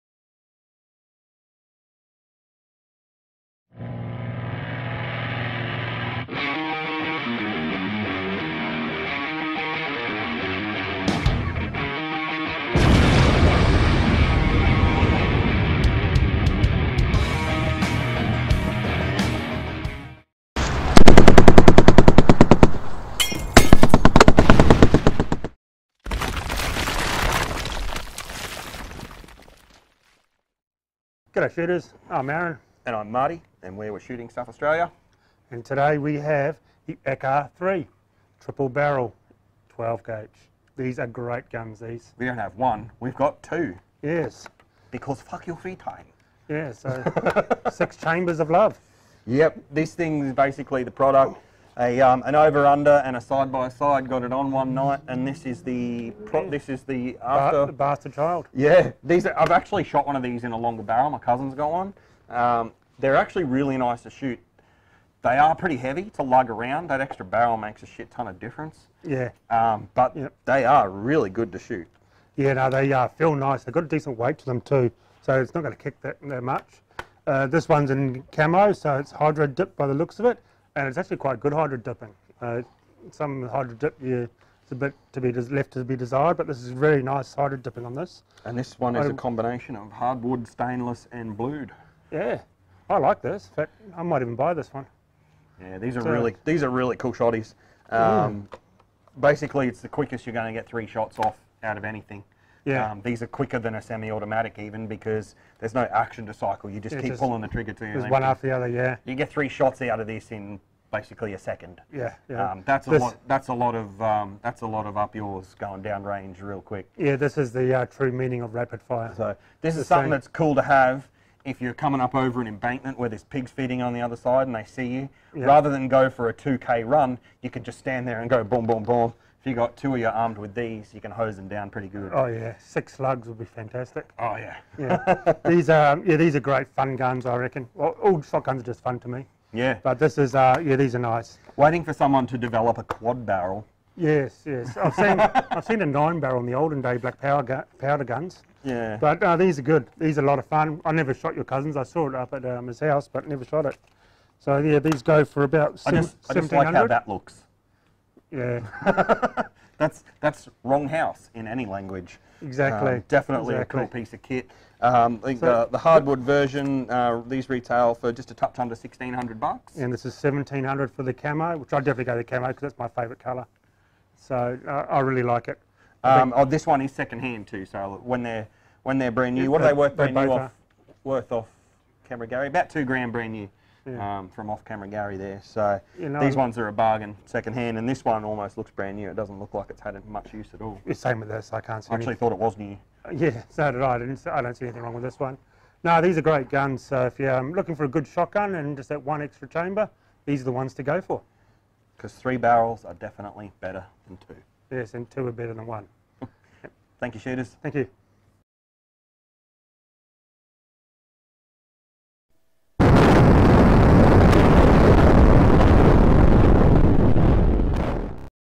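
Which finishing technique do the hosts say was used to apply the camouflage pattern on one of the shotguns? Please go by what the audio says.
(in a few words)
Hydro dipped.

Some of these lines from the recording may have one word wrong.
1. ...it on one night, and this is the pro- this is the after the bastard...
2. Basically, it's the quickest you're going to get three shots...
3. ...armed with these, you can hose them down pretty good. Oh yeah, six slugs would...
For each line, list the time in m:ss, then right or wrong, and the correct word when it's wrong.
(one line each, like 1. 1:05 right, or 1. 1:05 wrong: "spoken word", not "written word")
1. 0:54 right
2. 1:39 right
3. 2:10 right.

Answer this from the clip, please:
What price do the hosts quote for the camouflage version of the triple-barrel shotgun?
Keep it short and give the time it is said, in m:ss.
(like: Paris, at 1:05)
$1,700, at 2:50.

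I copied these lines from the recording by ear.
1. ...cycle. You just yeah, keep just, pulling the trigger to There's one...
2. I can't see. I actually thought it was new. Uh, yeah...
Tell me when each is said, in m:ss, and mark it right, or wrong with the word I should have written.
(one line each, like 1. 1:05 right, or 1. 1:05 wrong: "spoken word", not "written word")
1. 1:46 right
2. 3:11 right.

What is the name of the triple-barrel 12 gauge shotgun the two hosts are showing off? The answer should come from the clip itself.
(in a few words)
Akkar 3.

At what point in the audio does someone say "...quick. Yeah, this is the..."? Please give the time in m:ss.
1:56.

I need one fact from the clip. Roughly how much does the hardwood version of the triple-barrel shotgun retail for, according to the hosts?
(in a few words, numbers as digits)
Just under $1,600.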